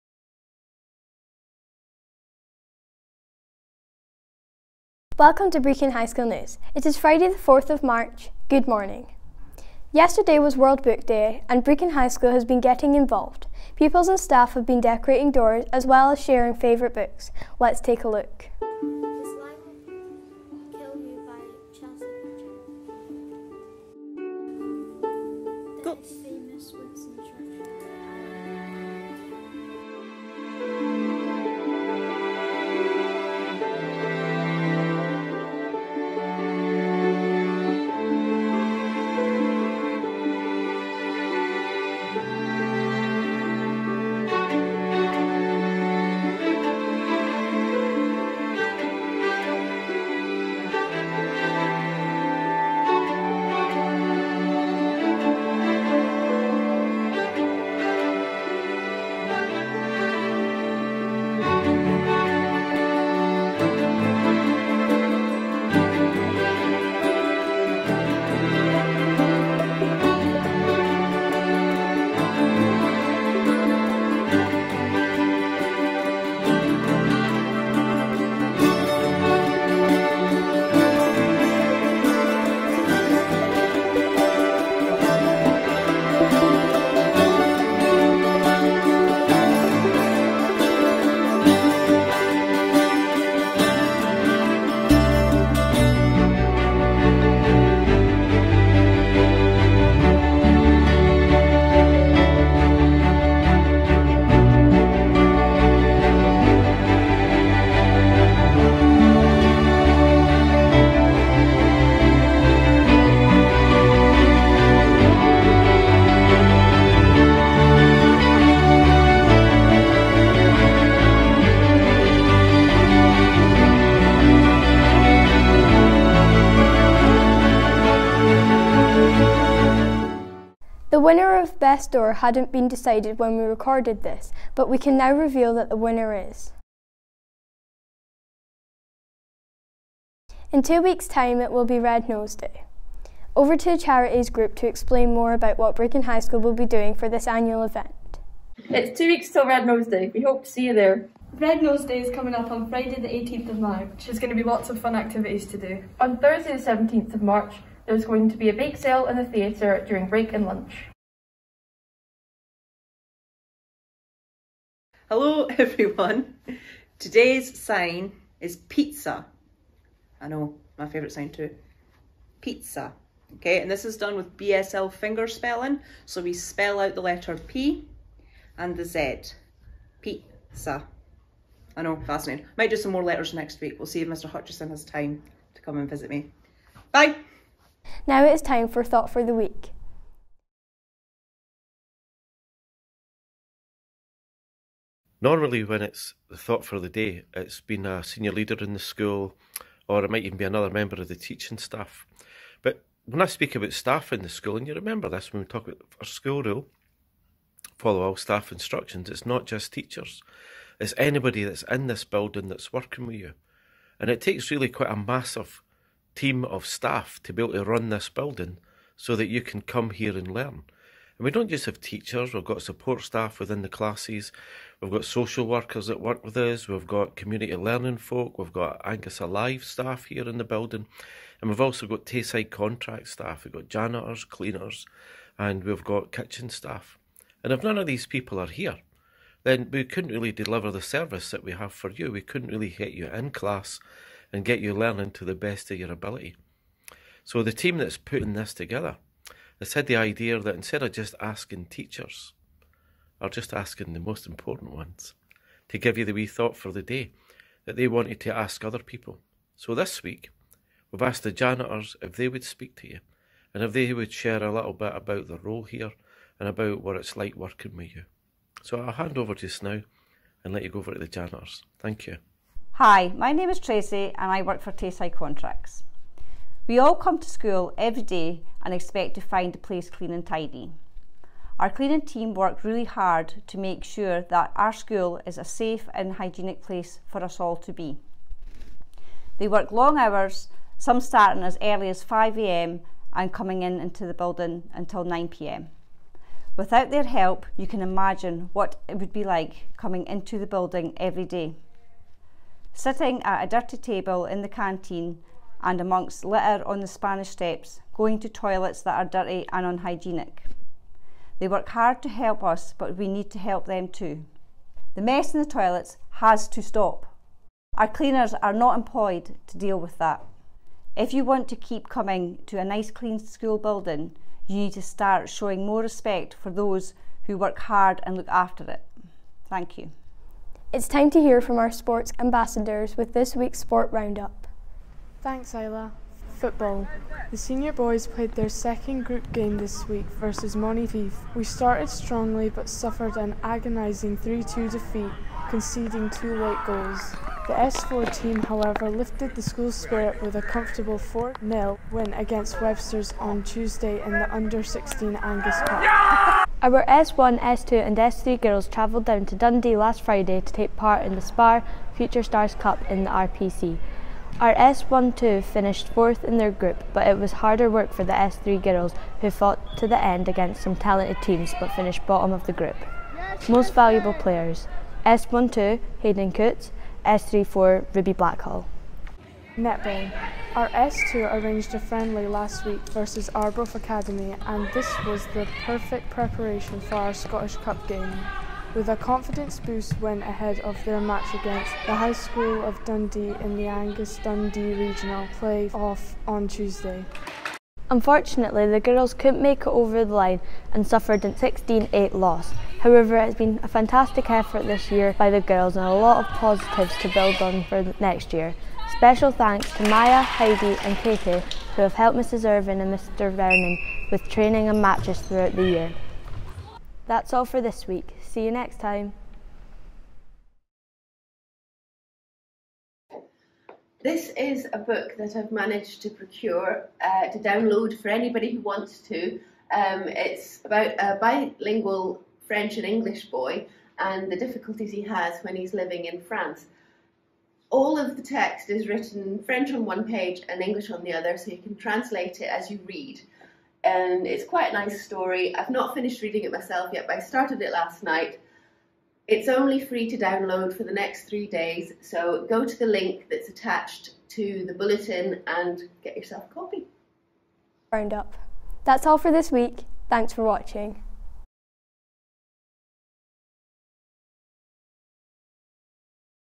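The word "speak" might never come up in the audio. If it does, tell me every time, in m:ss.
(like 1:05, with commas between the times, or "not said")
3:23, 4:22.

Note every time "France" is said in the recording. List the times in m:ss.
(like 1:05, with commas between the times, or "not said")
7:16.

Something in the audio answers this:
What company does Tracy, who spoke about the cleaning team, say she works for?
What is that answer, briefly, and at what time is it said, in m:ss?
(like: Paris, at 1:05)
Tayside Contracts, at 4:34.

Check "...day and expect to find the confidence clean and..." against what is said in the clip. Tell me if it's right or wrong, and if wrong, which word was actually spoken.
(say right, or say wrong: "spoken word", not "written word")
wrong: "place", not "confidence".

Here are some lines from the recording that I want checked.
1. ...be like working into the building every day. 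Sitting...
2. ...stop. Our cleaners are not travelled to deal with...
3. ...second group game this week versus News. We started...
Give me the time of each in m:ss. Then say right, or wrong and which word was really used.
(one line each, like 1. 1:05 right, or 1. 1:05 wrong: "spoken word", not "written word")
1. 4:59 wrong: "coming", not "working"
2. 5:16 wrong: "employed", not "travelled"
3. 5:38 wrong: "Monteith", not "News".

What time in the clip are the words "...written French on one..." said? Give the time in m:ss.
7:18.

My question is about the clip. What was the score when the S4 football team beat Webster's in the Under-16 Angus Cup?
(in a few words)
4-0.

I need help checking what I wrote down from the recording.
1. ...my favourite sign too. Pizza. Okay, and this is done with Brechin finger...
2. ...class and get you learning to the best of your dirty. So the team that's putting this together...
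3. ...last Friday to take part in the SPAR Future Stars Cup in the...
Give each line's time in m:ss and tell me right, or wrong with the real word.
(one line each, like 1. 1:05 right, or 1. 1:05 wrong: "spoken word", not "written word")
1. 2:50 wrong: "BSL", not "Brechin"
2. 4:03 wrong: "ability", not "dirty"
3. 5:59 right.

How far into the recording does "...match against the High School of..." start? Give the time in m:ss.
6:31.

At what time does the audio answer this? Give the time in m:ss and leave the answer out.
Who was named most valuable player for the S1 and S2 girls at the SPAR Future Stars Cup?
6:15.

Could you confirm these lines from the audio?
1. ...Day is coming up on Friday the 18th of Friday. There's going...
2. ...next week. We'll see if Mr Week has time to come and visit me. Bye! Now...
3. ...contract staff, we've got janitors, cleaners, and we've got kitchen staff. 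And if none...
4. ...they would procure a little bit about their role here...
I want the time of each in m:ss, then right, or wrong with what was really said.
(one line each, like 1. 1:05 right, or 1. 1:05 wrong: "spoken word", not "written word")
1. 2:31 wrong: "March", not "Friday"
2. 3:03 wrong: "Hutchison", not "Week"
3. 3:52 right
4. 4:23 wrong: "share", not "procure".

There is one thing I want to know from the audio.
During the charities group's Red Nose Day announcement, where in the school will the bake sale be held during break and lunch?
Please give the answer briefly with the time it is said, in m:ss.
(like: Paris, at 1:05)
the theatre, at 2:39.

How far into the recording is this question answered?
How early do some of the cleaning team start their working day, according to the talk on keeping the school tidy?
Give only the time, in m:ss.
4:52.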